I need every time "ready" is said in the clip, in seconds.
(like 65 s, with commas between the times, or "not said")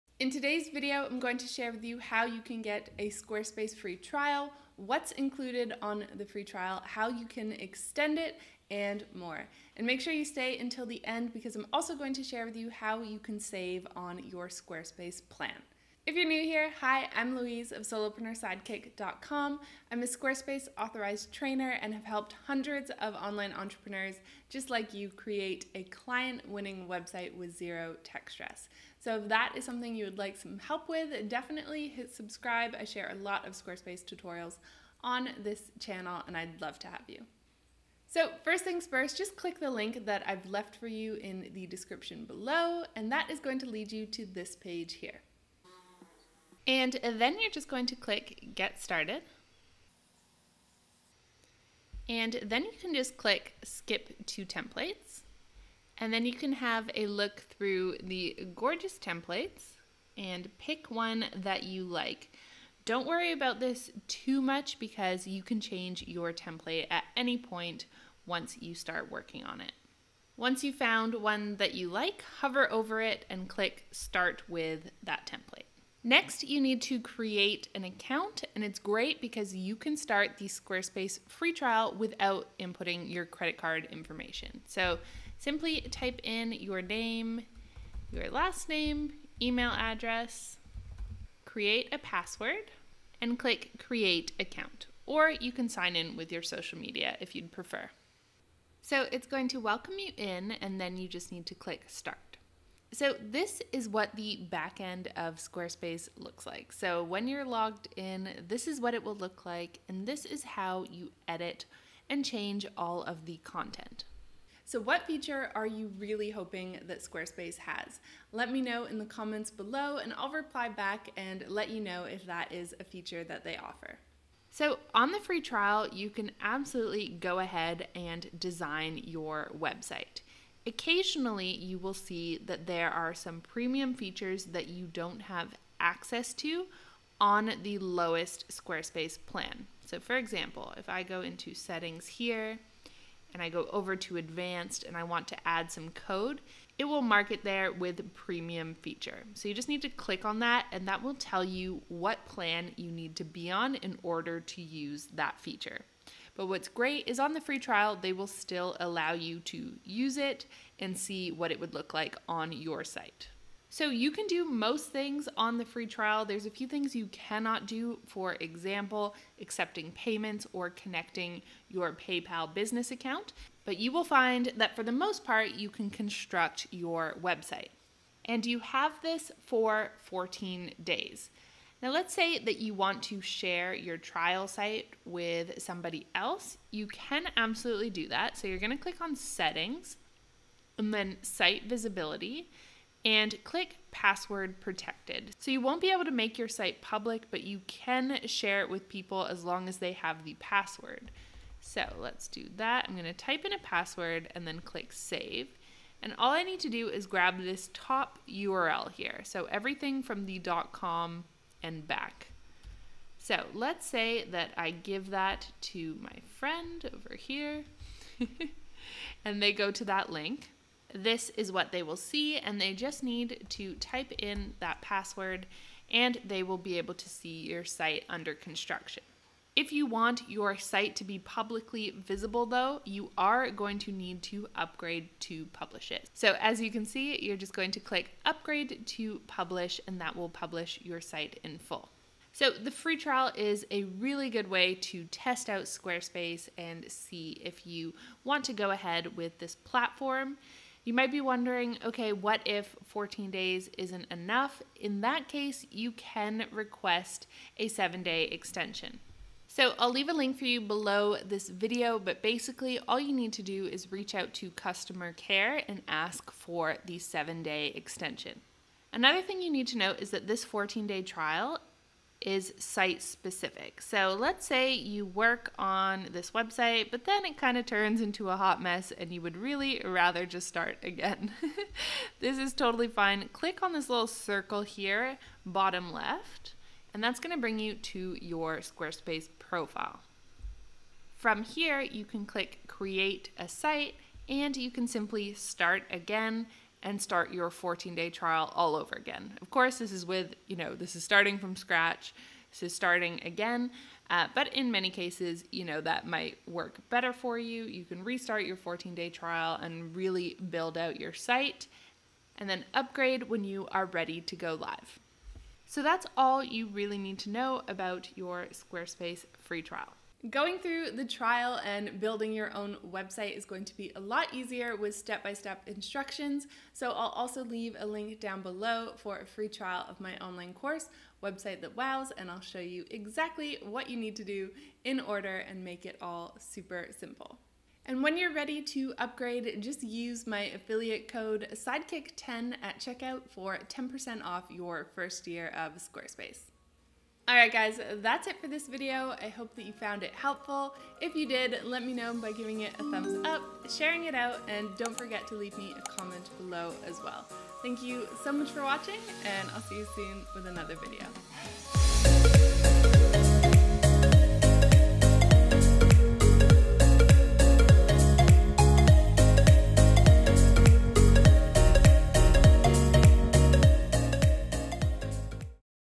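313 s, 338 s.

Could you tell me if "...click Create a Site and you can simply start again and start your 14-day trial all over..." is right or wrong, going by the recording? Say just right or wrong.
right.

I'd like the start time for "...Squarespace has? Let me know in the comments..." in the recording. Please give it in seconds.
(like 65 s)
117 s.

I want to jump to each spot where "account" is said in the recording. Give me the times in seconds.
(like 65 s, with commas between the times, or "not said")
77 s, 94 s, 172 s.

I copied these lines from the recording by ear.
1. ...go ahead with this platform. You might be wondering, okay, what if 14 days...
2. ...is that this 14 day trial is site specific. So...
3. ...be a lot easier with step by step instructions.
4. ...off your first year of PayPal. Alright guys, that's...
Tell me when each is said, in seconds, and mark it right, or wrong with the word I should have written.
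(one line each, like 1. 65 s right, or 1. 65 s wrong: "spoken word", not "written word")
1. 248 s right
2. 269 s right
3. 323 s right
4. 344 s wrong: "Squarespace", not "PayPal".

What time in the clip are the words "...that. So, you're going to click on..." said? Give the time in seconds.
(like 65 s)
188 s.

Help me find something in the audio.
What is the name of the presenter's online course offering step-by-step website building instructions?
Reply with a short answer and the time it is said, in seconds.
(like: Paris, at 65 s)
Website That Wows, at 331 s.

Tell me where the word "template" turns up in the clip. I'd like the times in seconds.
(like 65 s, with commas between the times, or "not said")
54 s, 58 s, 66 s, 75 s.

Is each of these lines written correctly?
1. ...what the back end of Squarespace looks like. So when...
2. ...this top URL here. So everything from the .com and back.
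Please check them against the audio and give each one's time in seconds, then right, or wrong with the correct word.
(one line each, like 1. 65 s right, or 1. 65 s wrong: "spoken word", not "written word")
1. 103 s right
2. 207 s right.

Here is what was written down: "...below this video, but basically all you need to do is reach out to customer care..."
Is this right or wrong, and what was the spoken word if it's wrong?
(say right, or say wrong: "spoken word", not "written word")
right.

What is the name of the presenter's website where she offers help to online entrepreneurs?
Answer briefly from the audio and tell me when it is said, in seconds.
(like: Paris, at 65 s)
solopreneursidekick.com, at 17 s.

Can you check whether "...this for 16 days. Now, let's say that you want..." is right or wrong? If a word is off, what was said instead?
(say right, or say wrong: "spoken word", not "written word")
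wrong: "14", not "16".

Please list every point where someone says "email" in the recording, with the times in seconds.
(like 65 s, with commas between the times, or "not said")
89 s.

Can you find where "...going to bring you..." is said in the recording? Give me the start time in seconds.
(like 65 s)
287 s.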